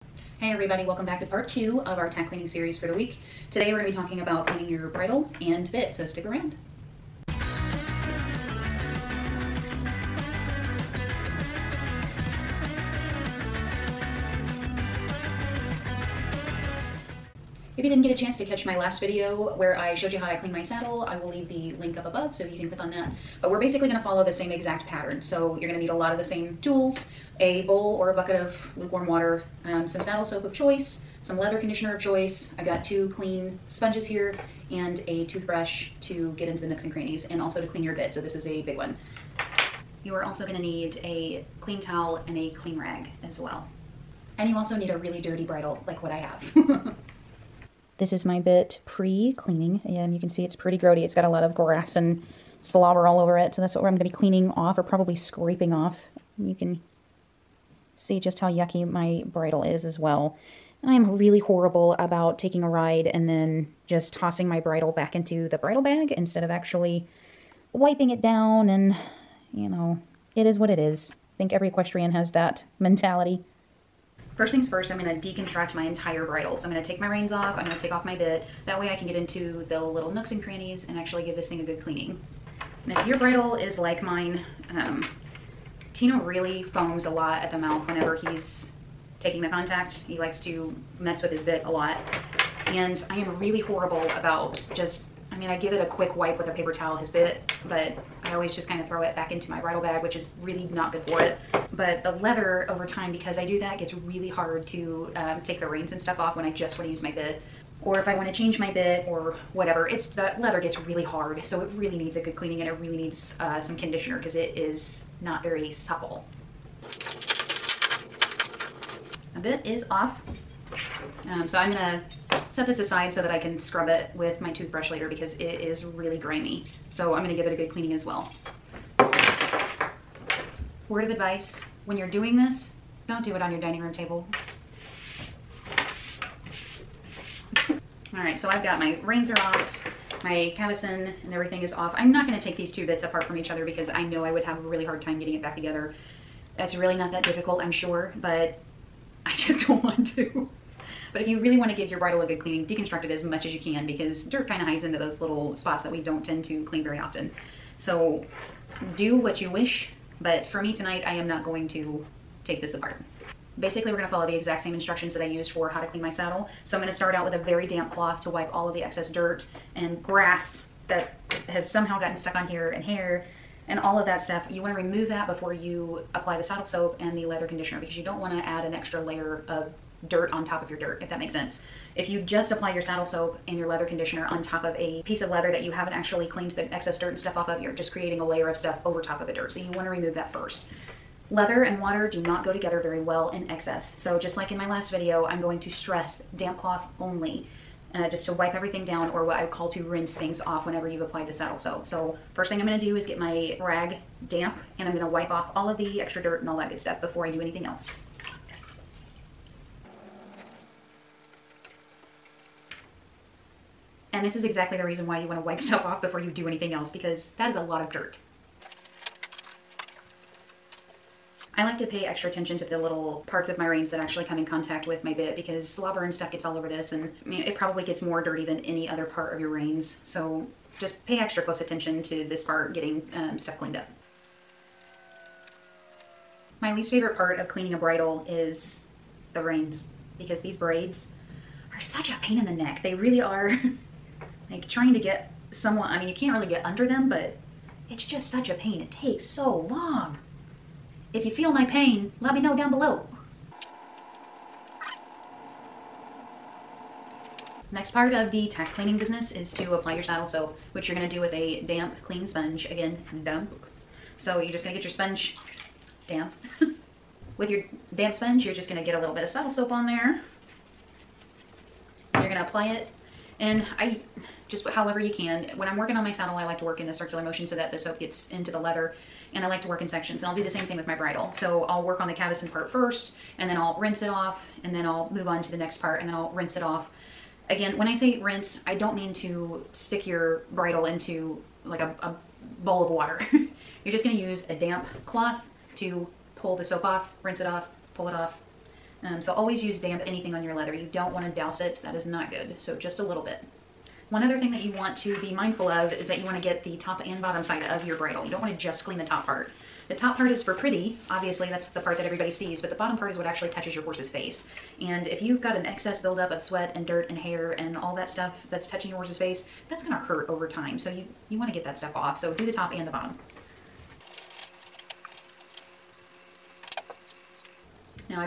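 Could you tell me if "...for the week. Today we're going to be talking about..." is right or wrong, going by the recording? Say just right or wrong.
right.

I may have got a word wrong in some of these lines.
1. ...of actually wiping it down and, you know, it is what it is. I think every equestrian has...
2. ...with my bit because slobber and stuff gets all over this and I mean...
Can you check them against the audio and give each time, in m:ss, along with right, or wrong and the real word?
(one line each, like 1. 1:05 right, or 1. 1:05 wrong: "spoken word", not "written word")
1. 1:06 right
2. 3:44 right.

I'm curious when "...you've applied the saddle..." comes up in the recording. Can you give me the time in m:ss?
3:20.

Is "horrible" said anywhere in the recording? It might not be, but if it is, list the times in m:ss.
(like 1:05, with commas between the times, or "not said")
1:01, 1:33.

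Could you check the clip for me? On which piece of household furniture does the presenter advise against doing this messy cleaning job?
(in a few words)
dining room table.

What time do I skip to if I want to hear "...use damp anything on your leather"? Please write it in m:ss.
4:59.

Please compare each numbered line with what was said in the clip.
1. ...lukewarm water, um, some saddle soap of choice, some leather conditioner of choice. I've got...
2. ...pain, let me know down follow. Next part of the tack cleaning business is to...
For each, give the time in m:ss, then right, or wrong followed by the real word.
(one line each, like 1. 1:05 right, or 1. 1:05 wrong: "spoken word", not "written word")
1. 0:28 right
2. 4:11 wrong: "below", not "follow".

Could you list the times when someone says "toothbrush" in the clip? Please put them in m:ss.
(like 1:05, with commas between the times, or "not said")
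0:35, 2:04.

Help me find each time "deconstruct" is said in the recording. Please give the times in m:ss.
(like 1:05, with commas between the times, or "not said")
1:15, 2:32.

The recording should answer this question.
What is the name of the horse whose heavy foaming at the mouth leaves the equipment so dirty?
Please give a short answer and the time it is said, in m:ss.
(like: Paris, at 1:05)
Tino, at 1:25.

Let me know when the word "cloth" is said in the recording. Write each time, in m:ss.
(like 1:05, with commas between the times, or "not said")
2:47, 3:16, 4:55.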